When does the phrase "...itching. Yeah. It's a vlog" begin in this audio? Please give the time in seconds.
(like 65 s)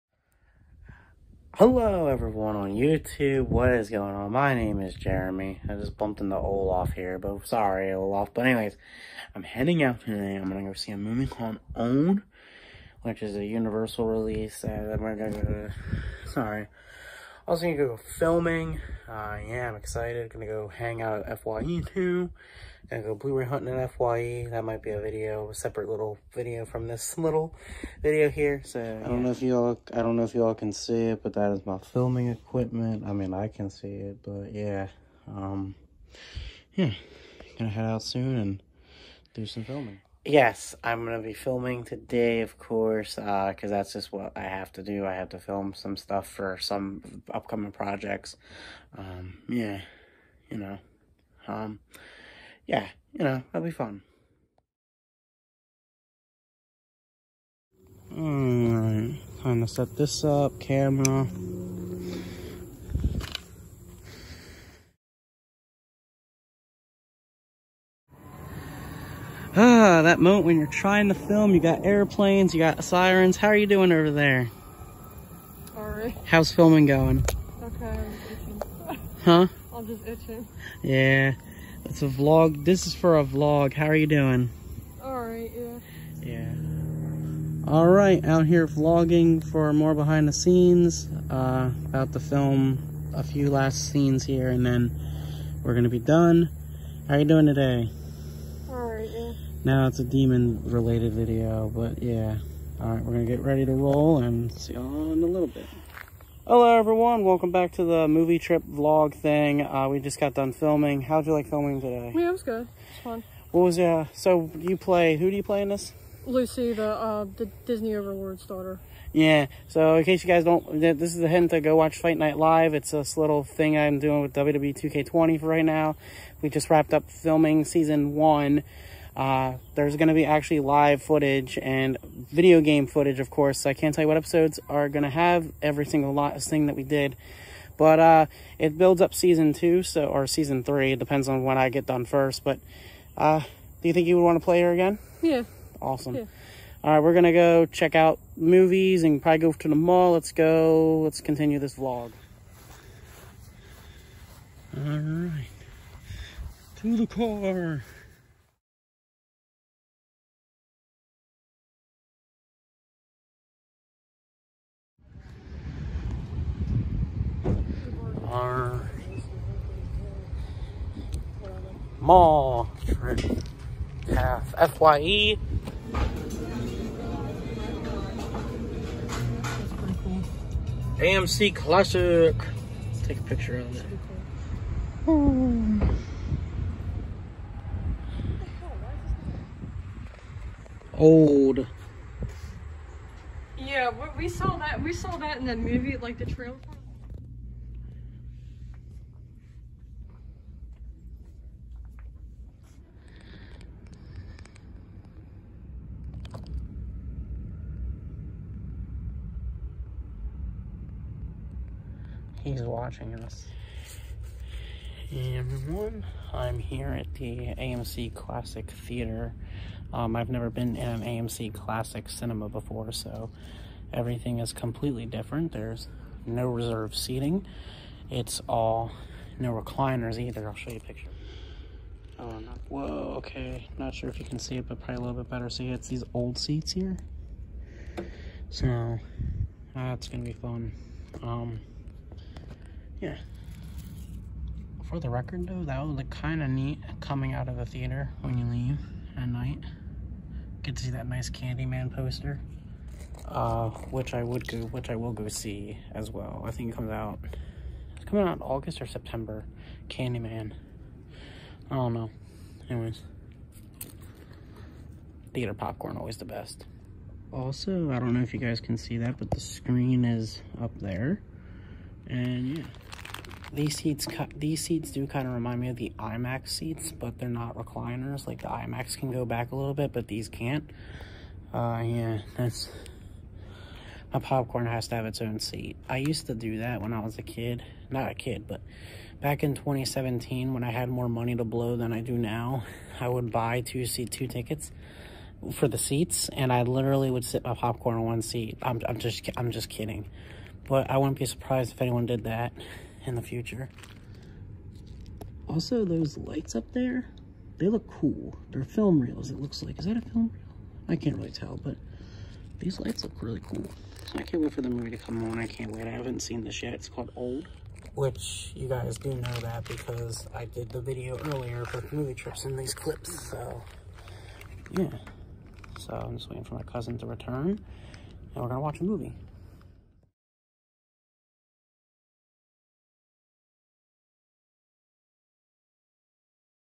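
80 s.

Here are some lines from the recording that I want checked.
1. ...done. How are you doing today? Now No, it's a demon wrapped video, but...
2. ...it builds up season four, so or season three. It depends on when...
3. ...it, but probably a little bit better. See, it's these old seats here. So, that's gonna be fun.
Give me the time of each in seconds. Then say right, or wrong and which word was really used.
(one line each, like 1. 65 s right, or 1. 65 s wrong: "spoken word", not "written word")
1. 95 s wrong: "related", not "wrapped"
2. 138 s wrong: "two", not "four"
3. 234 s right.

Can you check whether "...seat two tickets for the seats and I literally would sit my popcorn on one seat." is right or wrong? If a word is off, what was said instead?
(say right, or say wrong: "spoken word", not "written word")
right.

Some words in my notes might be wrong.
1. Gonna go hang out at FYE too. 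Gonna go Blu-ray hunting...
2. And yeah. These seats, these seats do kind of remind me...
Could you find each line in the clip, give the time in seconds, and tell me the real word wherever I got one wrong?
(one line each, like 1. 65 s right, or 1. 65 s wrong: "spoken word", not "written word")
1. 20 s right
2. 272 s right.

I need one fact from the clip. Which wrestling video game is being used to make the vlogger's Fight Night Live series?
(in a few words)
WWE 2K20.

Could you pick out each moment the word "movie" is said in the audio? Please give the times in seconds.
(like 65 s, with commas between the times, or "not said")
10 s, 108 s, 148 s, 195 s, 314 s, 321 s, 328 s.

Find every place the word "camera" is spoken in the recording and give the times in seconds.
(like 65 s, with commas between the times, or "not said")
60 s.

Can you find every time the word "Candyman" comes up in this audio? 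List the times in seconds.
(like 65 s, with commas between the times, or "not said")
251 s, 259 s.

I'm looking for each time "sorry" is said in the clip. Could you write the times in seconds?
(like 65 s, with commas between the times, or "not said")
7 s, 16 s.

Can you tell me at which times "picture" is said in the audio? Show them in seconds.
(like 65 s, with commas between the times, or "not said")
183 s, 230 s.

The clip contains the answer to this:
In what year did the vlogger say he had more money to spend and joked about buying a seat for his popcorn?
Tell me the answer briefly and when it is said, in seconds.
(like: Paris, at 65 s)
2017, at 289 s.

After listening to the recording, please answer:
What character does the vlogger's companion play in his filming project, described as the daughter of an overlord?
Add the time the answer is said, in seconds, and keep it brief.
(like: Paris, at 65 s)
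Lucy, at 116 s.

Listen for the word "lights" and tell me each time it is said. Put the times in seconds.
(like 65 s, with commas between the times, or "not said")
306 s, 312 s.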